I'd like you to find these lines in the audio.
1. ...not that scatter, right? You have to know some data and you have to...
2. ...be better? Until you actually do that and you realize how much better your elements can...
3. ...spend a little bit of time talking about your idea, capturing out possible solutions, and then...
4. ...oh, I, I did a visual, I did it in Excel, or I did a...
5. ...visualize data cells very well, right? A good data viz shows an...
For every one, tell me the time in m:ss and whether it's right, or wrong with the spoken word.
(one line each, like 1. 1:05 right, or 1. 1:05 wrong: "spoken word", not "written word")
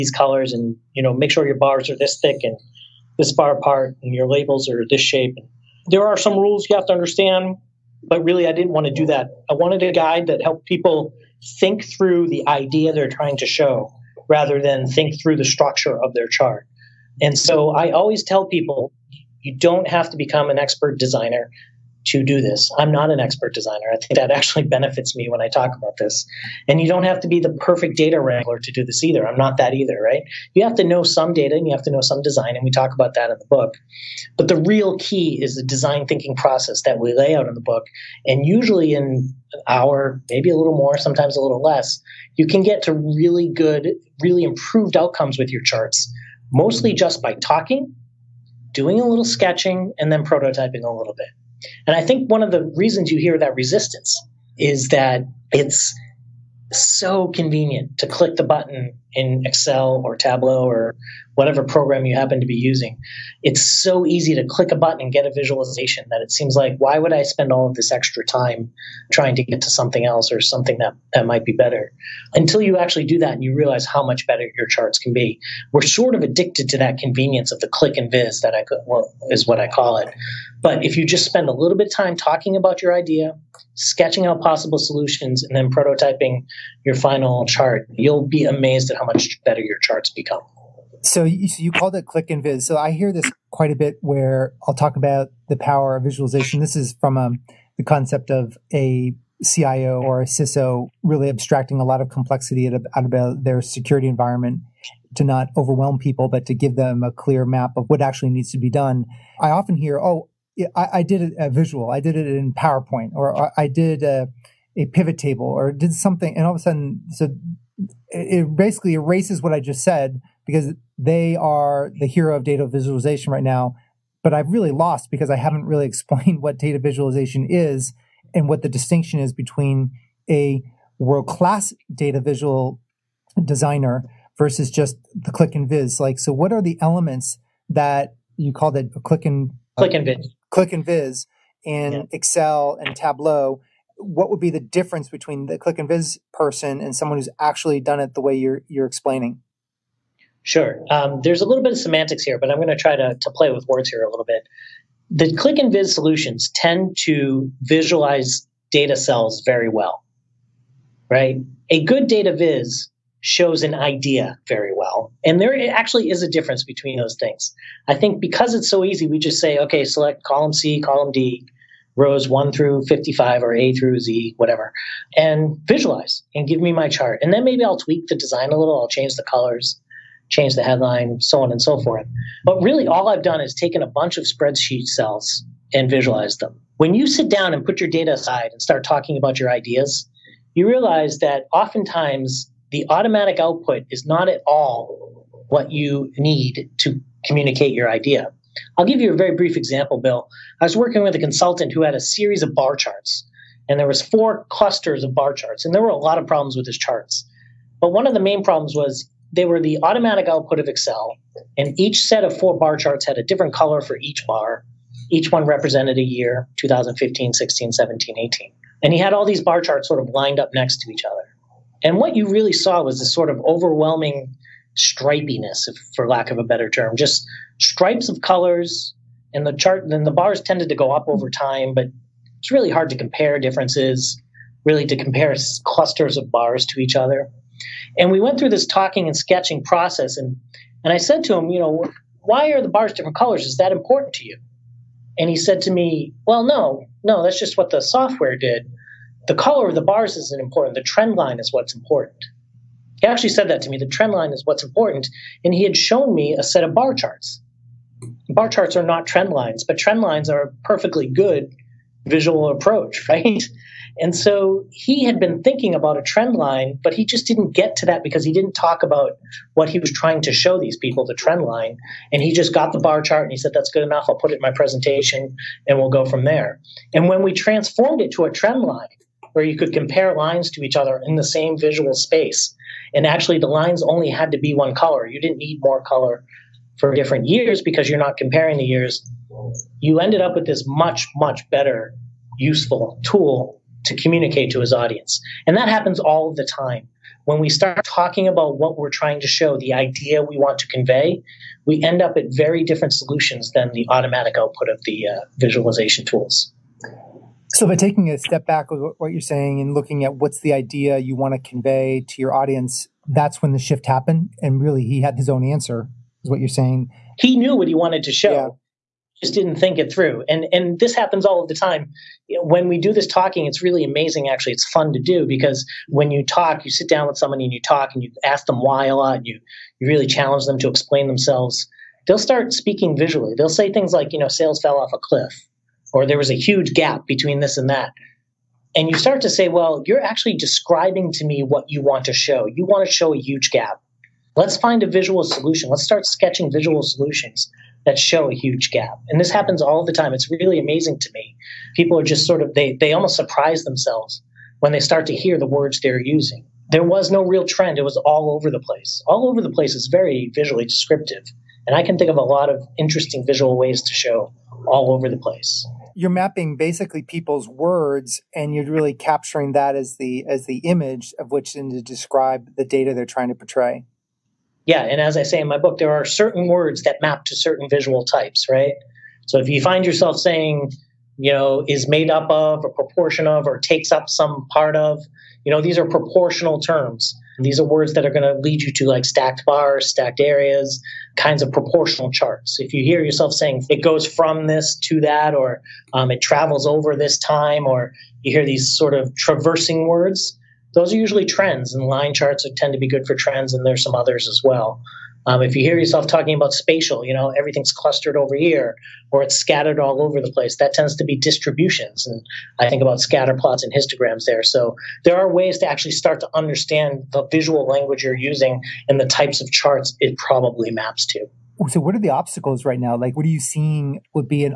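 1. 0:29 wrong: "either", not "scatter"
2. 1:11 wrong: "charts", not "elements"
3. 1:21 wrong: "sketching", not "capturing"
4. 1:49 wrong: "PowerPoint", not "Excel"
5. 2:37 right.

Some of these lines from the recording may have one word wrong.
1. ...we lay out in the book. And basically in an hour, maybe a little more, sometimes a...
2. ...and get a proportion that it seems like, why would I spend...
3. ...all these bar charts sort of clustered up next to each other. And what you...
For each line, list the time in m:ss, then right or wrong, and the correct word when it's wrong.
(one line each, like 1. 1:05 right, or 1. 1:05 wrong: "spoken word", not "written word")
1. 0:36 wrong: "usually", not "basically"
2. 1:05 wrong: "visualization", not "proportion"
3. 3:39 wrong: "lined", not "clustered".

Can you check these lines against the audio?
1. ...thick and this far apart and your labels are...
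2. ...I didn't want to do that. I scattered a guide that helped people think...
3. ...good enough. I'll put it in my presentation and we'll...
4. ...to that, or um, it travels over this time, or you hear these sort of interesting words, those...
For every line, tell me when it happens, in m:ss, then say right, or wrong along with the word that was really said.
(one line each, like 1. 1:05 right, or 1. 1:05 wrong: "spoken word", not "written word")
1. 0:02 right
2. 0:08 wrong: "wanted", not "scattered"
3. 4:33 right
4. 6:34 wrong: "traversing", not "interesting".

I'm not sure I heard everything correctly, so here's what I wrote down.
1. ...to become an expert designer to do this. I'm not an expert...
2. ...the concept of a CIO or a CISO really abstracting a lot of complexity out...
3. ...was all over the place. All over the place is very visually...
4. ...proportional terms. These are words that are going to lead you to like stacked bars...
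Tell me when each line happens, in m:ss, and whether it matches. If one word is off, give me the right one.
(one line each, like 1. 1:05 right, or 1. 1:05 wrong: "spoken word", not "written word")
1. 0:20 right
2. 1:37 right
3. 5:57 right
4. 6:25 right.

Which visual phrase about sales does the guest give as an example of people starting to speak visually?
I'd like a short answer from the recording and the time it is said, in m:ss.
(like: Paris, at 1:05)
fell off a cliff, at 5:34.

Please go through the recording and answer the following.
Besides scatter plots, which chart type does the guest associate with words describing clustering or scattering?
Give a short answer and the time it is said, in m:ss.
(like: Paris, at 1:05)
histograms, at 6:53.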